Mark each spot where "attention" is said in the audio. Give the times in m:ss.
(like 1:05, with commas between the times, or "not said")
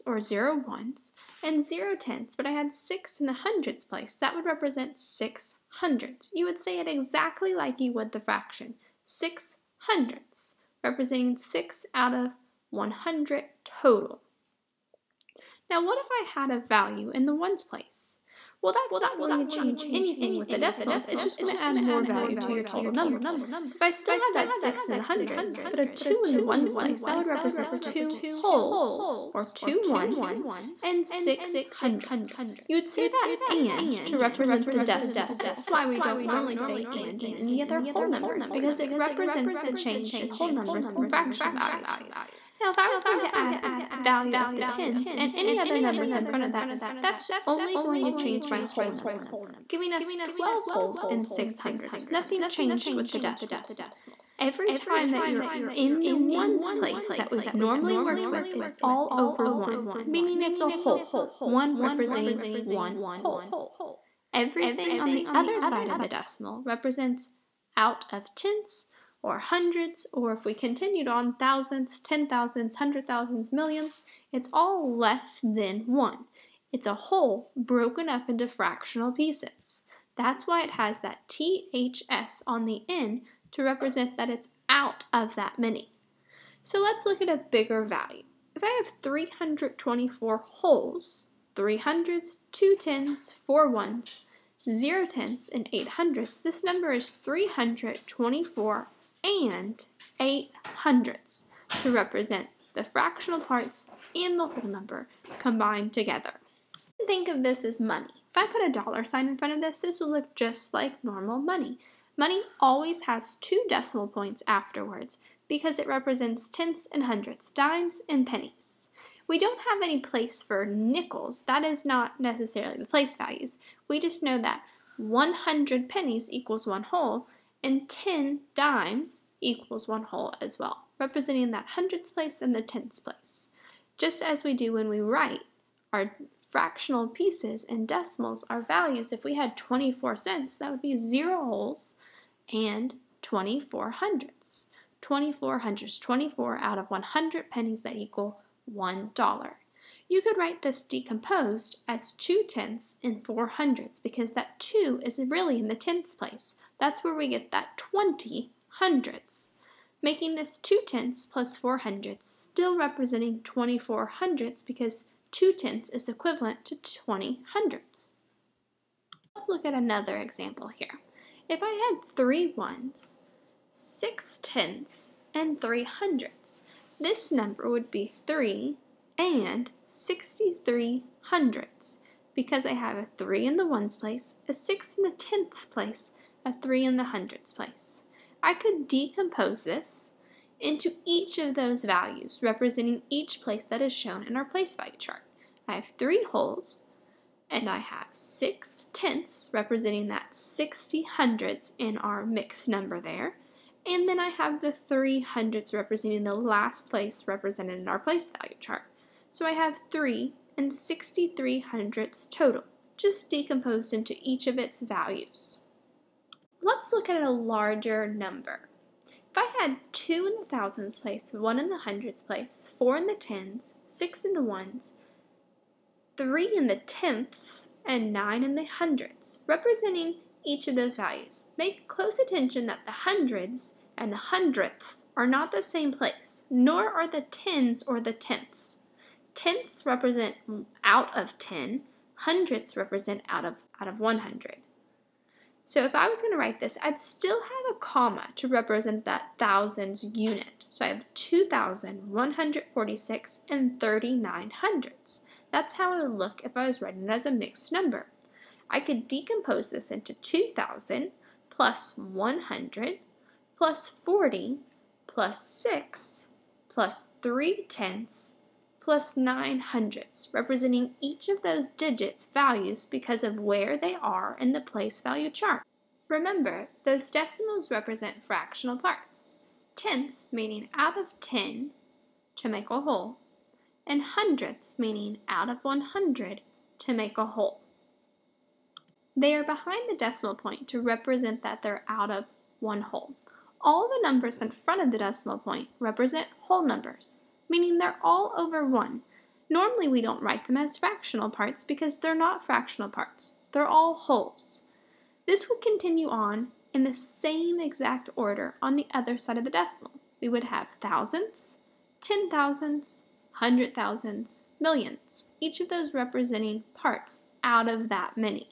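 3:52.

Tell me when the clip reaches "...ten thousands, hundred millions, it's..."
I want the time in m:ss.
1:11.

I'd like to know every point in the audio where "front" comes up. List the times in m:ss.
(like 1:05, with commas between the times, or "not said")
0:46, 1:49, 4:54.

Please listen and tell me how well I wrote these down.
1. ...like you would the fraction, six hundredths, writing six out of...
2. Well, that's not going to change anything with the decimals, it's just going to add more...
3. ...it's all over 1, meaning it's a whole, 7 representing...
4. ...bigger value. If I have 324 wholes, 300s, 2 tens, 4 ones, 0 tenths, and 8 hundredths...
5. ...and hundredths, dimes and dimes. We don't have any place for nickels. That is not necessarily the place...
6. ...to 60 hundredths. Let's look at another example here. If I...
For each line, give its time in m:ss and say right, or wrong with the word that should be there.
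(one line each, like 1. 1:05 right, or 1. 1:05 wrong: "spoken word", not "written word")
1. 0:07 wrong: "representing", not "writing"
2. 0:18 right
3. 0:58 wrong: "1", not "7"
4. 1:27 right
5. 1:56 wrong: "pennies", not "dimes"
6. 2:46 wrong: "20", not "60".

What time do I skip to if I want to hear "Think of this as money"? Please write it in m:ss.
1:47.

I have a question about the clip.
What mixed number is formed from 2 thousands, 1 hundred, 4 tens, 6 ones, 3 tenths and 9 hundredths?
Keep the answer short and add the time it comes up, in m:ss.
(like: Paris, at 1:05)
2,146 and 39 hundredths, at 4:11.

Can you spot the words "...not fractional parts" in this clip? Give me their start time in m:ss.
5:02.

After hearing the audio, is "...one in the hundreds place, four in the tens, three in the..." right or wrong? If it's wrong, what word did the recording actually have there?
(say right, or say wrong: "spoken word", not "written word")
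wrong: "six", not "three".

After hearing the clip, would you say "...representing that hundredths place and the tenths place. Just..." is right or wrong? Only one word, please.
right.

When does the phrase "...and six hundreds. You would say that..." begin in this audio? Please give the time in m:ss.
0:30.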